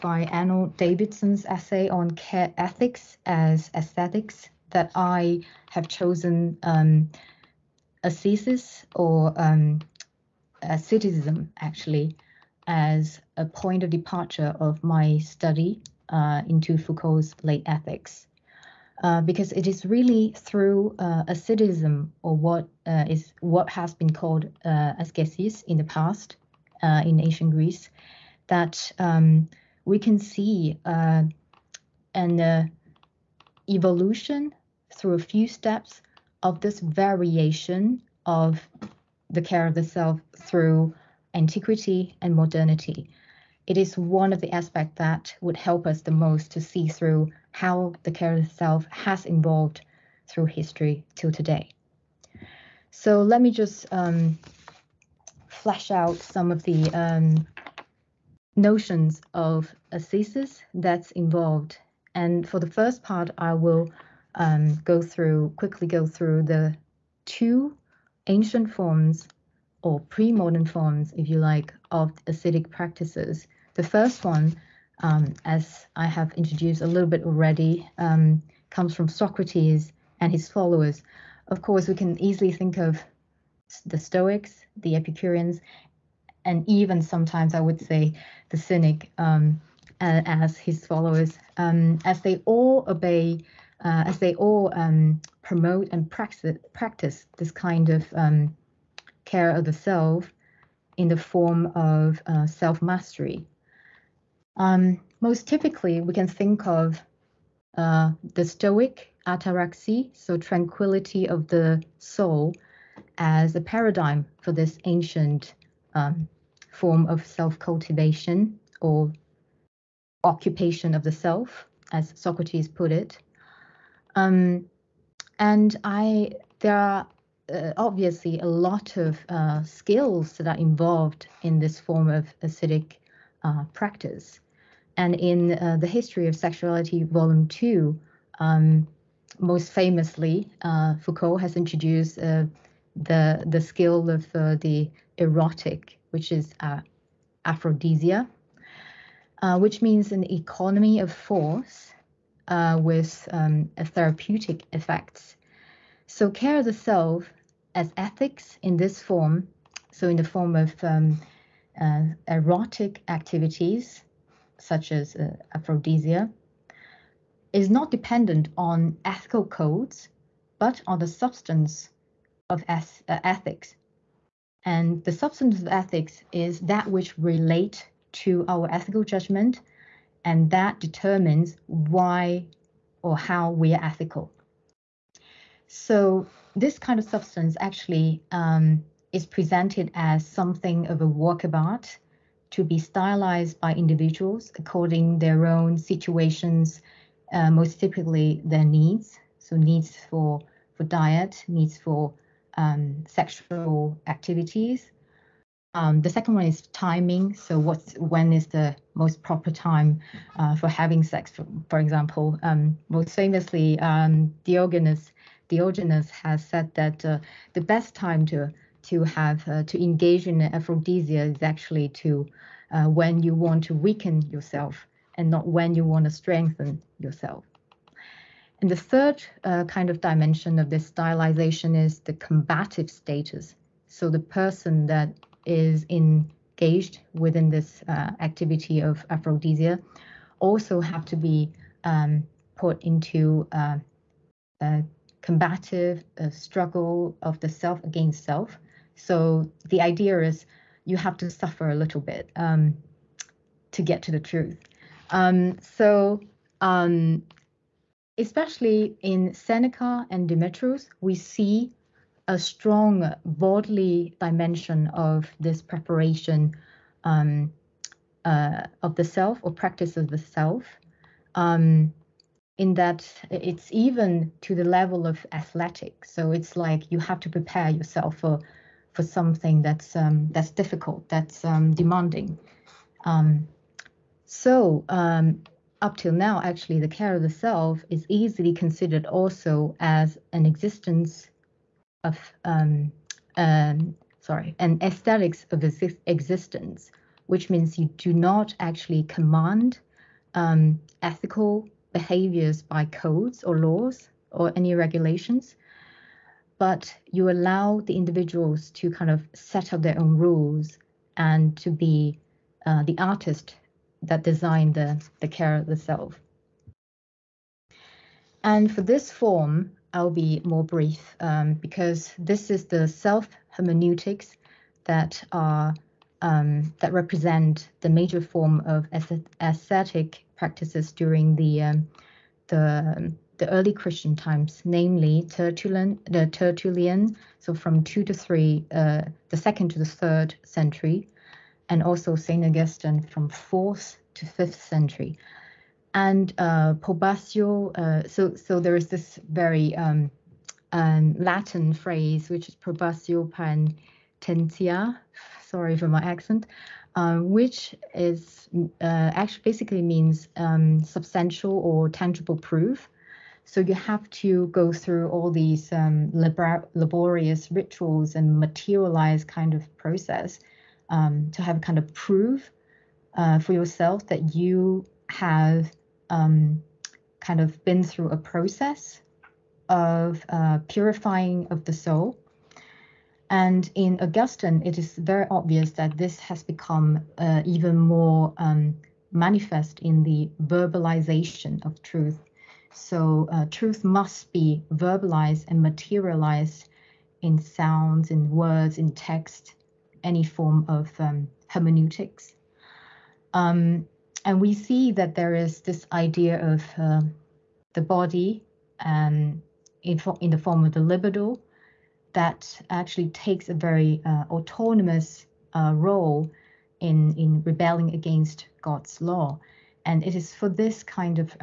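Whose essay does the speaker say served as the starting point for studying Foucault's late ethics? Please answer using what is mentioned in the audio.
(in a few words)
Arnold Davidson.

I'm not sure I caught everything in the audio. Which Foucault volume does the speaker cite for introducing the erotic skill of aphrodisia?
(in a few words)
History of Sexuality, Volume Two.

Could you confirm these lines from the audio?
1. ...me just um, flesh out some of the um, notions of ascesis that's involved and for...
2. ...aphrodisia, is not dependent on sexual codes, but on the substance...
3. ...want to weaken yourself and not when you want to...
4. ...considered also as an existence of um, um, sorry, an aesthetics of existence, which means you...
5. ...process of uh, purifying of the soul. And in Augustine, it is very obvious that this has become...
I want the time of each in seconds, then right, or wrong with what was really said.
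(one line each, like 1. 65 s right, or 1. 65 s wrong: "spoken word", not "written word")
1. 53 s right
2. 165 s wrong: "ethical", not "sexual"
3. 223 s right
4. 288 s right
5. 378 s right.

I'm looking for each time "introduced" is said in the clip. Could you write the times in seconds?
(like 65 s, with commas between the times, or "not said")
76 s, 141 s.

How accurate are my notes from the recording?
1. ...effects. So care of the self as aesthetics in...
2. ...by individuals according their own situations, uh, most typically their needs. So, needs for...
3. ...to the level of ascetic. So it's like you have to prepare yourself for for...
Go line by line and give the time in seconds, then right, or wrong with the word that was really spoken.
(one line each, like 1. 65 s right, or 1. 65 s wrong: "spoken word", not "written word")
1. 154 s wrong: "ethics", not "aesthetics"
2. 193 s right
3. 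274 s wrong: "athletic", not "ascetic".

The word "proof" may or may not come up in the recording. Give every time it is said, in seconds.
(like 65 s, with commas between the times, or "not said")
362 s, 371 s.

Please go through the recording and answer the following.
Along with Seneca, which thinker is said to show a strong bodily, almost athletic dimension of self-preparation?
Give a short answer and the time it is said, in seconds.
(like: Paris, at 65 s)
Demetrius, at 260 s.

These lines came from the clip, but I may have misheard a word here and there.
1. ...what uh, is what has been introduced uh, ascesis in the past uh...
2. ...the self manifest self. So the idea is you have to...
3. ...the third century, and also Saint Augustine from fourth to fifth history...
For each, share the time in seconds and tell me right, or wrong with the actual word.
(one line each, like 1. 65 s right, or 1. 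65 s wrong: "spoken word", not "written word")
1. 22 s wrong: "called", not "introduced"
2. 247 s wrong: "against", not "manifest"
3. 339 s wrong: "century", not "history".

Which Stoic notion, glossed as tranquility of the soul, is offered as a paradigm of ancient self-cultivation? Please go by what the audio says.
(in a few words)
ataraxy.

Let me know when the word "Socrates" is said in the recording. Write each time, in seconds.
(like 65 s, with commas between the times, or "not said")
79 s, 122 s.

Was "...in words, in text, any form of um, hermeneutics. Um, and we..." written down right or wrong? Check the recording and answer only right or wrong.
right.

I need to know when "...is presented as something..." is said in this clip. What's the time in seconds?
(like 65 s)
189 s.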